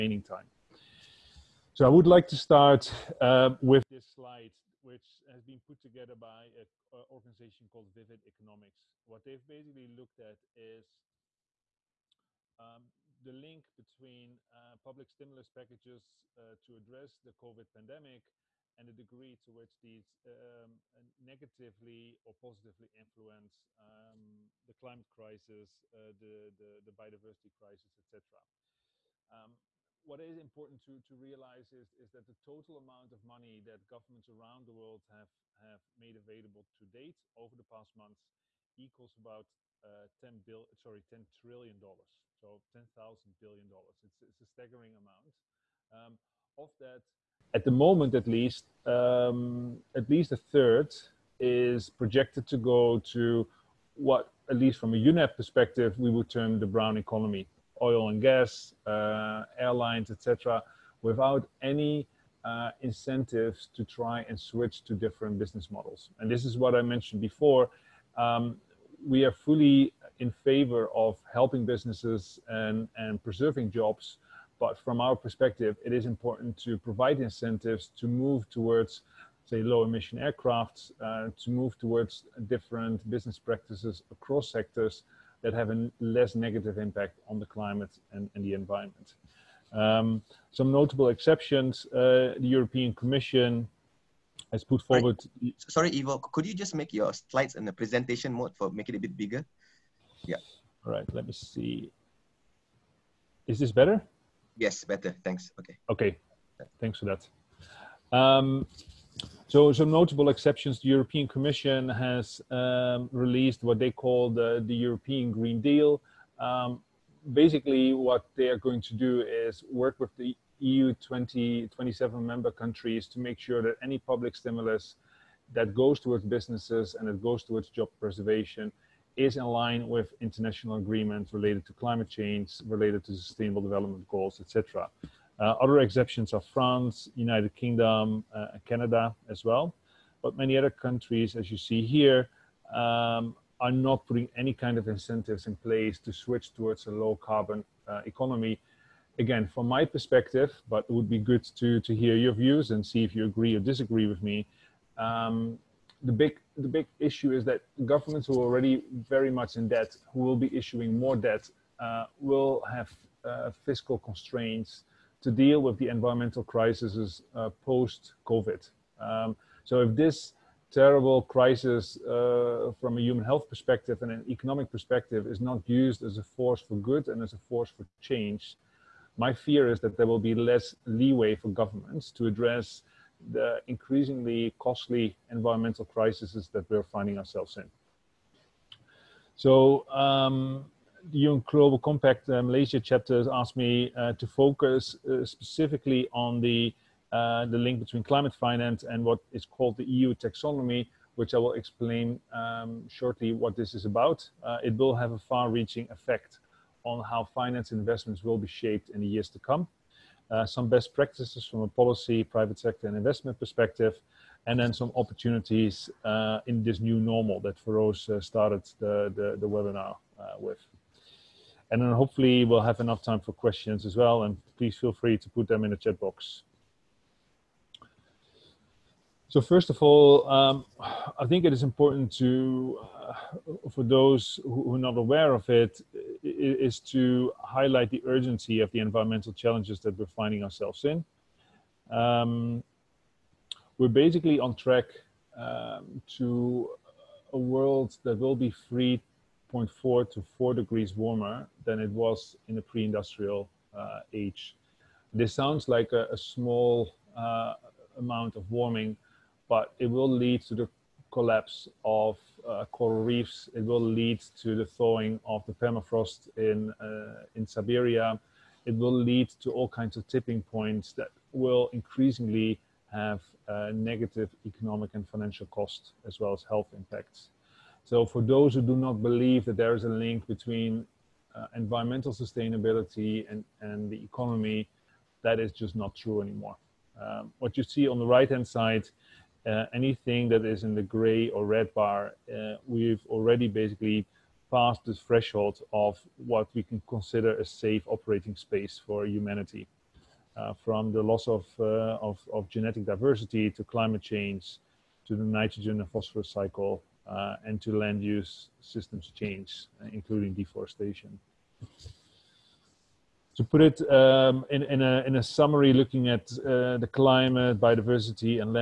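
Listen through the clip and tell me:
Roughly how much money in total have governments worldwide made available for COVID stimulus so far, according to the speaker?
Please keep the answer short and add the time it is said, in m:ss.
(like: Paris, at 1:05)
10 trillion dollars, at 0:41.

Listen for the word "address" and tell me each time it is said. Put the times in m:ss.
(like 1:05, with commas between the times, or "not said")
0:16, 3:02.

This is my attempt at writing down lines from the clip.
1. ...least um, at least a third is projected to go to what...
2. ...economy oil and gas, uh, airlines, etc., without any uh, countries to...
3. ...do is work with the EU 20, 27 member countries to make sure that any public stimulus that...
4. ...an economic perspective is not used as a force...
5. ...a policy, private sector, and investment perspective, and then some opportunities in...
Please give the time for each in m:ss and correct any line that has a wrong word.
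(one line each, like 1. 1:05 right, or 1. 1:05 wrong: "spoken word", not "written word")
1. 0:48 right
2. 0:56 wrong: "incentives", not "countries"
3. 1:58 right
4. 2:54 right
5. 3:31 right.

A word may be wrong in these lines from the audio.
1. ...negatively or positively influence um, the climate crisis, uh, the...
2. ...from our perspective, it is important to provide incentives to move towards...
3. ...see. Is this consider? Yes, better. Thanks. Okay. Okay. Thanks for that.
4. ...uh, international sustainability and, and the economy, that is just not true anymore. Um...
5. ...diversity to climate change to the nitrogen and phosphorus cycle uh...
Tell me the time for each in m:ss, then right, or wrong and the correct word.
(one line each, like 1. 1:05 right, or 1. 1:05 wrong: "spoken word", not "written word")
1. 0:21 right
2. 1:14 right
3. 1:41 wrong: "better", not "consider"
4. 4:41 wrong: "environmental", not "international"
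5. 5:02 right.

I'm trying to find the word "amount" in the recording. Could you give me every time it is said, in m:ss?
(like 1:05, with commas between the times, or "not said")
0:32, 0:44, 4:17.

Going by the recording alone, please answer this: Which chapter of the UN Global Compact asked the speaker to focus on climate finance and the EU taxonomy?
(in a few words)
Malaysia.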